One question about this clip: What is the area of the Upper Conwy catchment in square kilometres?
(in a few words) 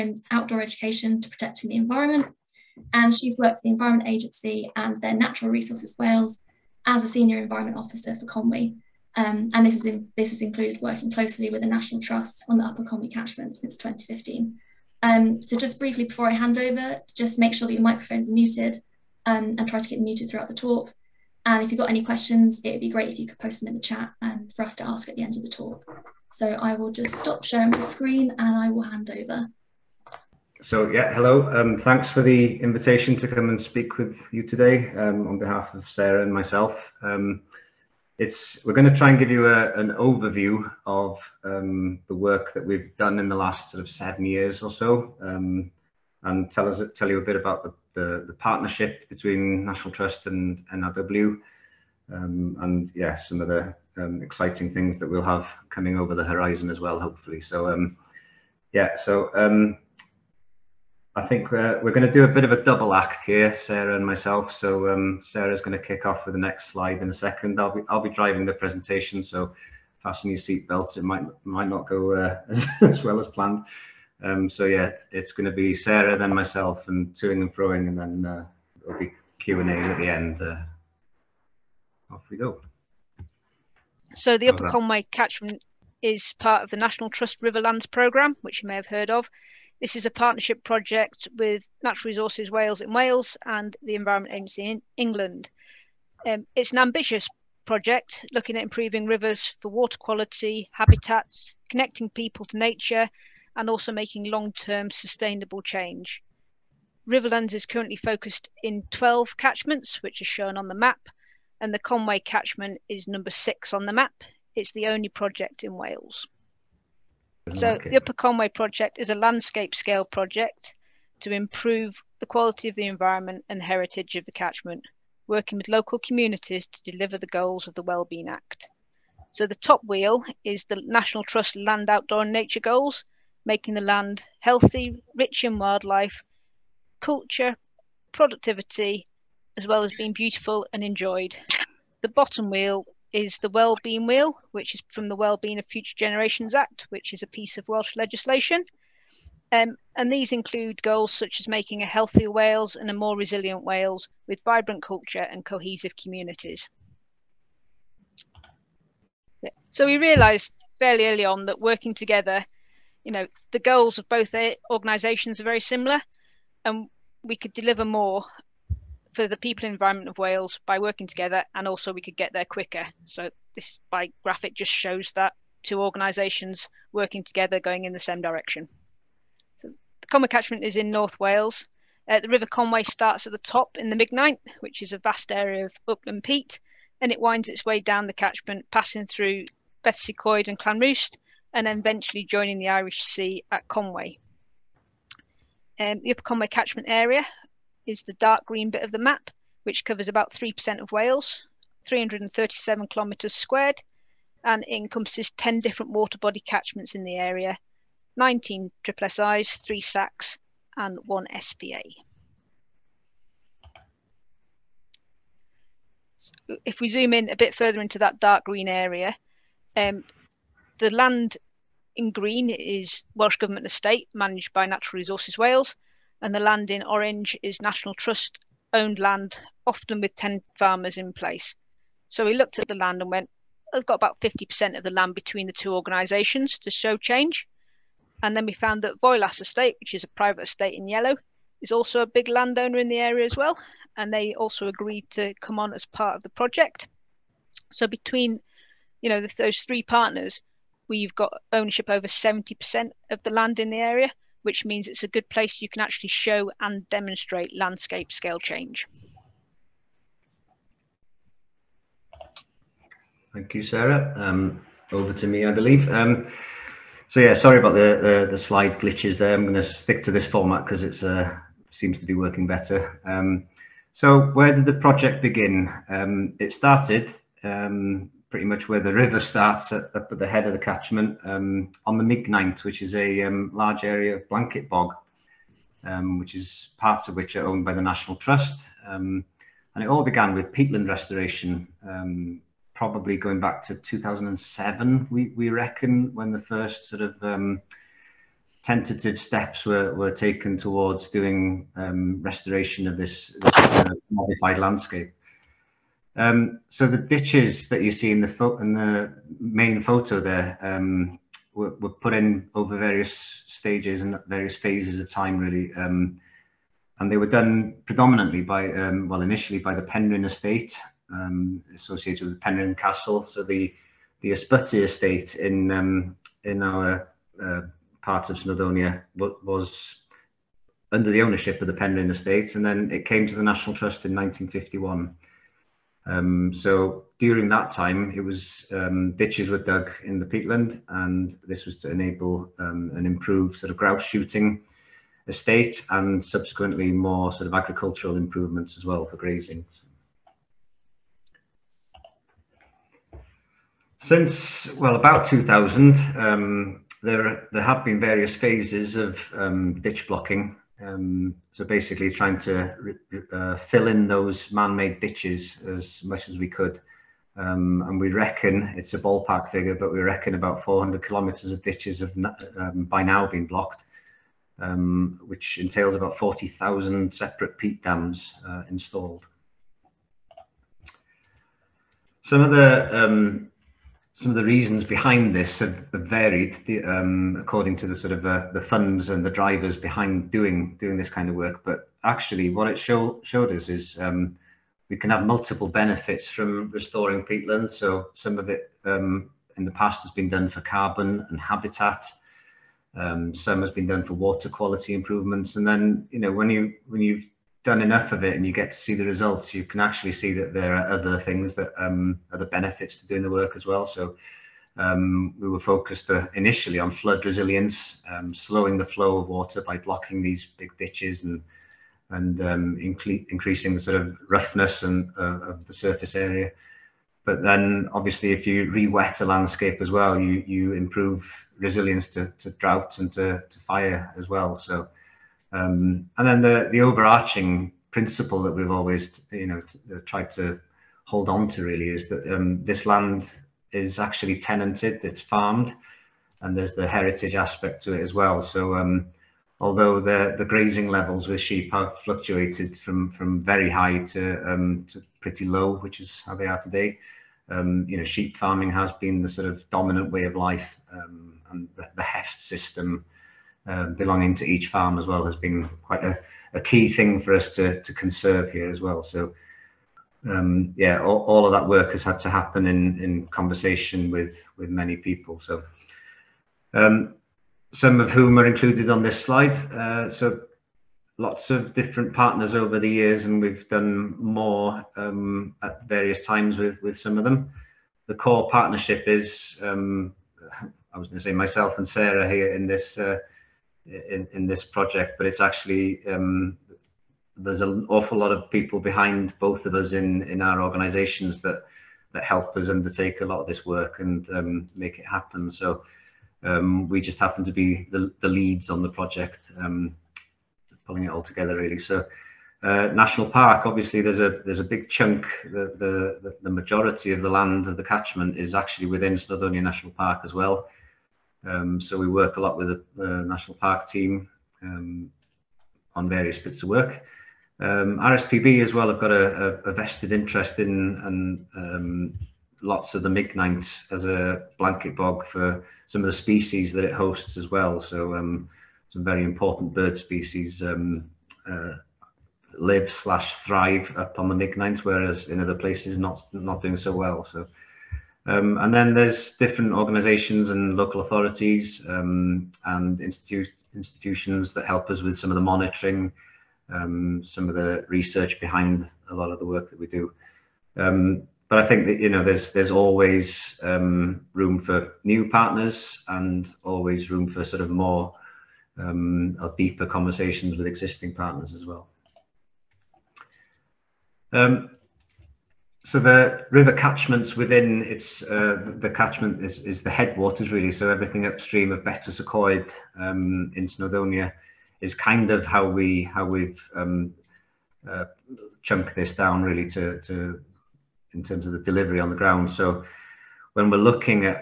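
337.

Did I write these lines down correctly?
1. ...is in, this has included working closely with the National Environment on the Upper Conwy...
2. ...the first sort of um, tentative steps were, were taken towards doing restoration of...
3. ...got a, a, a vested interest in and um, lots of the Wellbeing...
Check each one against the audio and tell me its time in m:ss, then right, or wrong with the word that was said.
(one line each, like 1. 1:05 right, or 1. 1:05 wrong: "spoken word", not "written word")
1. 0:09 wrong: "Trust", not "Environment"
2. 4:56 right
3. 8:49 wrong: "Migneint", not "Wellbeing".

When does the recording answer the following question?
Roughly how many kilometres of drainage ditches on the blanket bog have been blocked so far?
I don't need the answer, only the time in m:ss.
6:10.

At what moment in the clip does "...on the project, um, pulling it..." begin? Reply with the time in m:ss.
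8:28.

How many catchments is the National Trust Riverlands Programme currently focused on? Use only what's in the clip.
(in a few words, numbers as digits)
12.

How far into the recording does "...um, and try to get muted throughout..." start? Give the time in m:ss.
0:19.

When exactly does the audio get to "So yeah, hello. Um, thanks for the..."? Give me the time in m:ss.
0:30.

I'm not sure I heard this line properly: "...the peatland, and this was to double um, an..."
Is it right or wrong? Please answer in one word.
wrong.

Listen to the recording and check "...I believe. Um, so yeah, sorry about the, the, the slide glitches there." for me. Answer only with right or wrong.
right.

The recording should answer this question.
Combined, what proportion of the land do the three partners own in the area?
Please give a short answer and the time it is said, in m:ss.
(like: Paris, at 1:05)
over 70%, at 4:11.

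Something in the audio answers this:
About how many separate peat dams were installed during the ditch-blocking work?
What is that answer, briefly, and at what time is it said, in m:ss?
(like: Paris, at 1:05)
40,000, at 6:16.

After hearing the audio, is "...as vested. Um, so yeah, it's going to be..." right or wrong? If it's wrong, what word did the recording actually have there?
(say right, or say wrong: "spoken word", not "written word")
wrong: "planned", not "vested".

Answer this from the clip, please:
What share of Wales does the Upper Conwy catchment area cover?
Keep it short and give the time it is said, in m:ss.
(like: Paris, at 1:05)
3%, at 3:20.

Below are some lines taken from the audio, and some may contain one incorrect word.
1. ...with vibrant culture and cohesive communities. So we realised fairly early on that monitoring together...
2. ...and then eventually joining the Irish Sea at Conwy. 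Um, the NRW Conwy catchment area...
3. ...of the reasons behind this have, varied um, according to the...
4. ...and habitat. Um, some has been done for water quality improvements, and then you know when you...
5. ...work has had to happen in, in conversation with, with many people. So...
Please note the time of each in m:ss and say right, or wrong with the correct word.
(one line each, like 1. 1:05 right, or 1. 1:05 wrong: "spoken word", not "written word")
1. 2:34 wrong: "working", not "monitoring"
2. 3:11 wrong: "Upper", not "NRW"
3. 6:24 right
4. 6:41 right
5. 7:51 right.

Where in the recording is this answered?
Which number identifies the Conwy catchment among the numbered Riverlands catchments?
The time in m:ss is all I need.
1:53.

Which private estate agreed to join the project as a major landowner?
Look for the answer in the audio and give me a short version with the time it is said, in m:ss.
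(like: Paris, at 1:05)
Voelas Estate, at 3:59.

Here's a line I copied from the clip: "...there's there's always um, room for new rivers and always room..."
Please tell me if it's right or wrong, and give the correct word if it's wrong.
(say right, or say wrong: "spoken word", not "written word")
wrong: "partners", not "rivers".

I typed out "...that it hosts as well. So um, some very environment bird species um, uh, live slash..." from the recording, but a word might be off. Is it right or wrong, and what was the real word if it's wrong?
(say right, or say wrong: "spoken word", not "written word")
wrong: "important", not "environment".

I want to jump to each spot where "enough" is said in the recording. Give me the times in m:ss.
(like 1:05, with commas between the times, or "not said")
6:47.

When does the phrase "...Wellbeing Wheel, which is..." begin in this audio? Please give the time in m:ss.
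2:23.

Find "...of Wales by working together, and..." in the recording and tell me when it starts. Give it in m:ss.
2:50.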